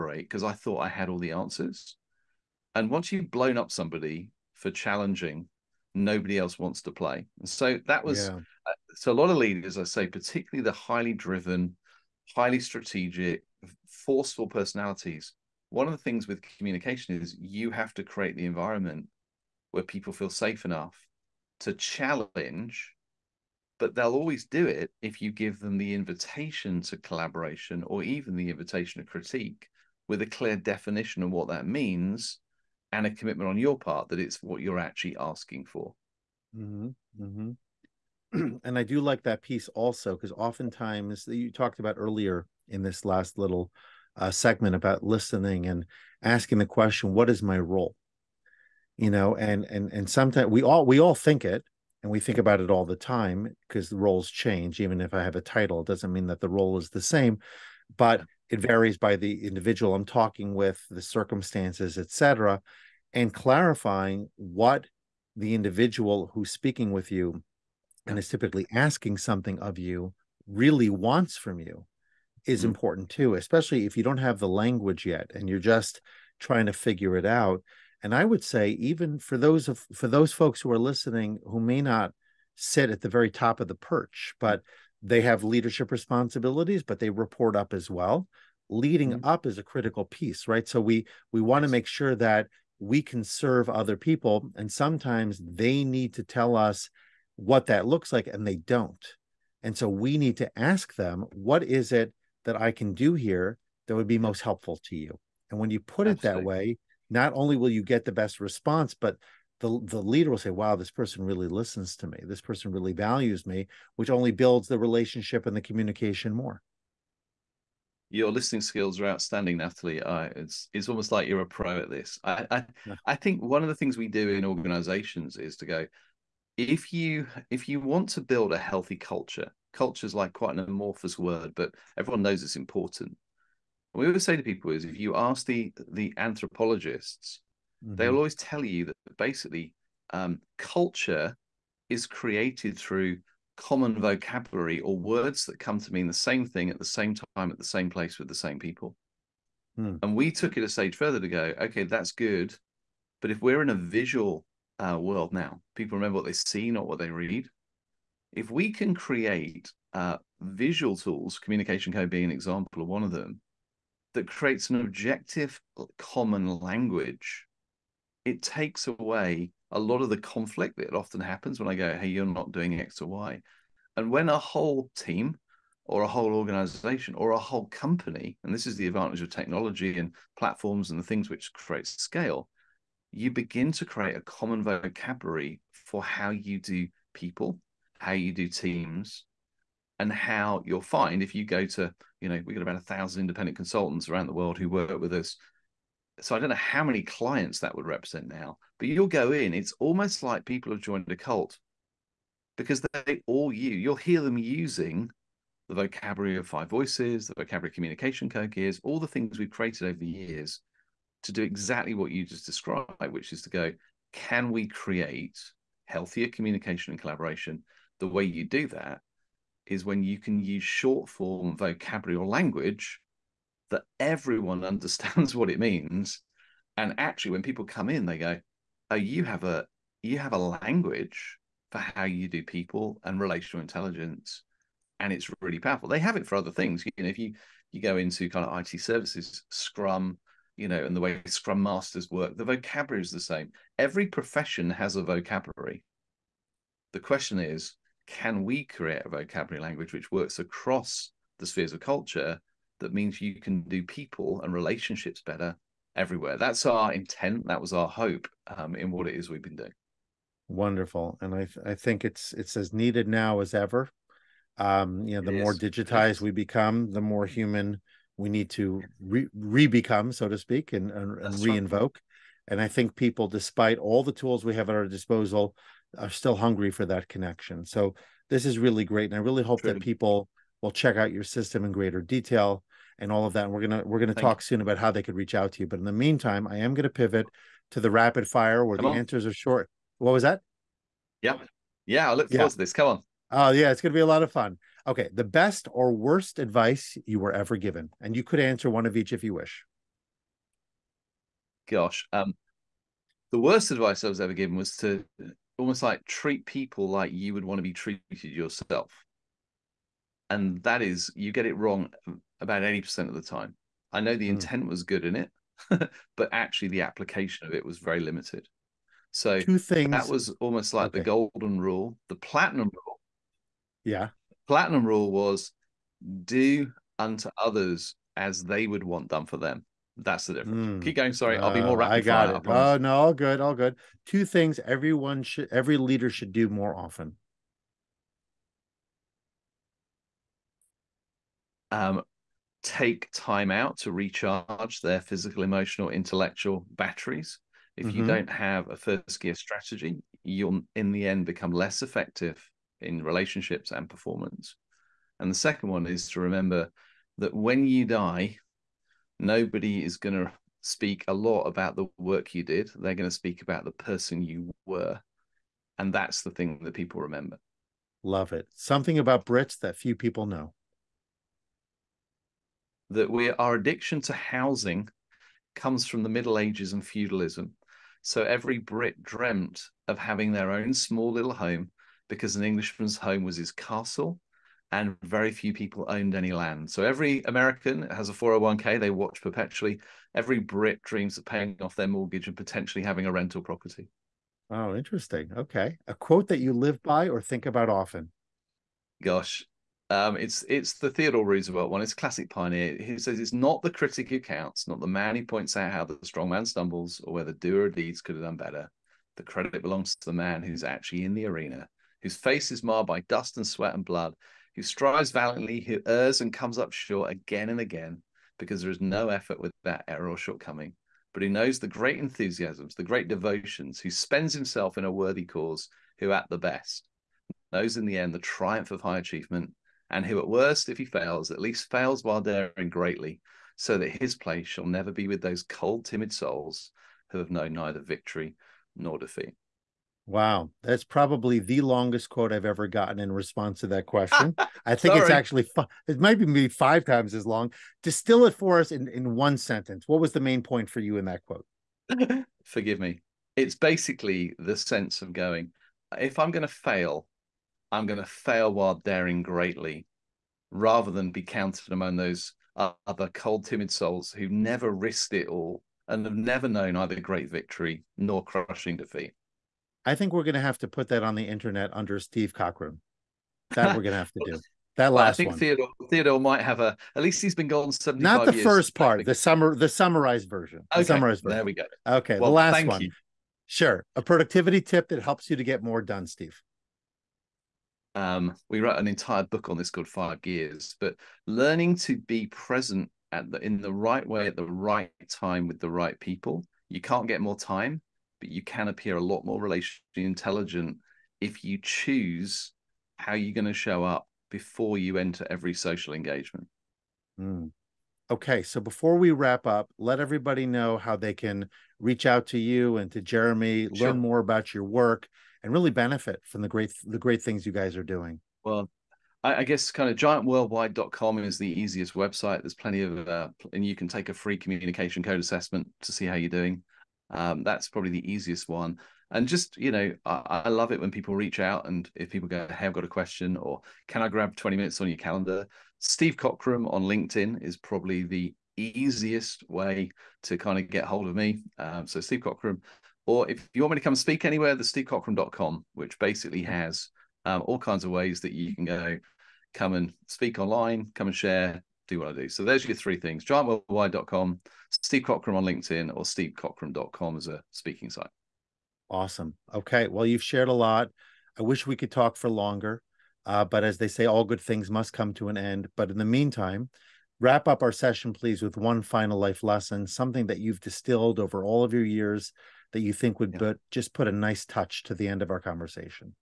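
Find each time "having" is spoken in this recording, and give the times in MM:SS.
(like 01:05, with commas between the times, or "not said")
06:19, 06:32.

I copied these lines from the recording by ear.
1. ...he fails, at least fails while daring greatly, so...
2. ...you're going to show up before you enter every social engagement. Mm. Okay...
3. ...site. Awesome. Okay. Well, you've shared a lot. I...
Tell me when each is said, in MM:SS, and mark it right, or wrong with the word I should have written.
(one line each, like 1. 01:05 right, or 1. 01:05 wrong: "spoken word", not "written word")
1. 07:10 right
2. 08:23 right
3. 09:17 right.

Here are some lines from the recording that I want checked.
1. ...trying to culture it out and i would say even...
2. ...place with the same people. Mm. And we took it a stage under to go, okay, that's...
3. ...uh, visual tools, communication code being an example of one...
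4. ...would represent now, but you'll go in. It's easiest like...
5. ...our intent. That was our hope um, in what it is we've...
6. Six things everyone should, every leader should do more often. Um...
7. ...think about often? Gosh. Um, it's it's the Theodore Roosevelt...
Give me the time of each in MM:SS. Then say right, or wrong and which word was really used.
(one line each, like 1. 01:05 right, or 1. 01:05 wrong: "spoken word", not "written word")
1. 01:16 wrong: "figure", not "culture"
2. 02:27 wrong: "further", not "under"
3. 02:39 right
4. 03:17 wrong: "almost", not "easiest"
5. 04:16 right
6. 05:34 wrong: "Two", not "Six"
7. 06:37 right.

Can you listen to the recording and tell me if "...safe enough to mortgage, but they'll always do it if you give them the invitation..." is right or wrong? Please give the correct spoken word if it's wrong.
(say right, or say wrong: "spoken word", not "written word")
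wrong: "challenge", not "mortgage".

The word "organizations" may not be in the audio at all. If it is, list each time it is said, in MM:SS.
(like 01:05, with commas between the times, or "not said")
02:04, 02:56.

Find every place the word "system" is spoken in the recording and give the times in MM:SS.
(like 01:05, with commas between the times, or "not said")
04:41.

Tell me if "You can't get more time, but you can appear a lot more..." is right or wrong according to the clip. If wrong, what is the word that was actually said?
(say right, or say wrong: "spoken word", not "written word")
right.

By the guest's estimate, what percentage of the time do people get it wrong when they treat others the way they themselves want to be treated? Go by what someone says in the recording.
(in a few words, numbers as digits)
80%.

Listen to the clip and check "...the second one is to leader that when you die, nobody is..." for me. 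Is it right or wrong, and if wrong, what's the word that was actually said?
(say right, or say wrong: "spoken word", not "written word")
wrong: "remember", not "leader".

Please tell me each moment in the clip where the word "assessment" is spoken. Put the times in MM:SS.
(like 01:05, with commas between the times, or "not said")
08:45.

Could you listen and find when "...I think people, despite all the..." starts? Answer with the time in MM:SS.
04:32.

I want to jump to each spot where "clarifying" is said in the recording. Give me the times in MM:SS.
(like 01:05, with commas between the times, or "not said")
01:03.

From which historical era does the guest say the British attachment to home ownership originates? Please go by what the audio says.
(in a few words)
The Middle Ages.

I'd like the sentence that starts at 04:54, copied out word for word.
Okay, the best or worst advice you were ever given, and you could answer one of each if you wish.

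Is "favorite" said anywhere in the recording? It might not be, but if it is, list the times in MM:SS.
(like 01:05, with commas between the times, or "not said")
not said.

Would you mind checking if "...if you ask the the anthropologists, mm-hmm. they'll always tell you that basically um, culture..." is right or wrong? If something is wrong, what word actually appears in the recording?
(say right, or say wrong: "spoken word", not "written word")
right.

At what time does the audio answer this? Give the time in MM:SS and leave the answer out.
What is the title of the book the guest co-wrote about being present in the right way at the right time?
08:09.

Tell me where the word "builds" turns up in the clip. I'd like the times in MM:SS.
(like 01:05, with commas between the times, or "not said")
01:54, 02:08.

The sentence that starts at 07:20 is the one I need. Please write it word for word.
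Wow, that's probably the longest quote I've ever gotten in response to that question.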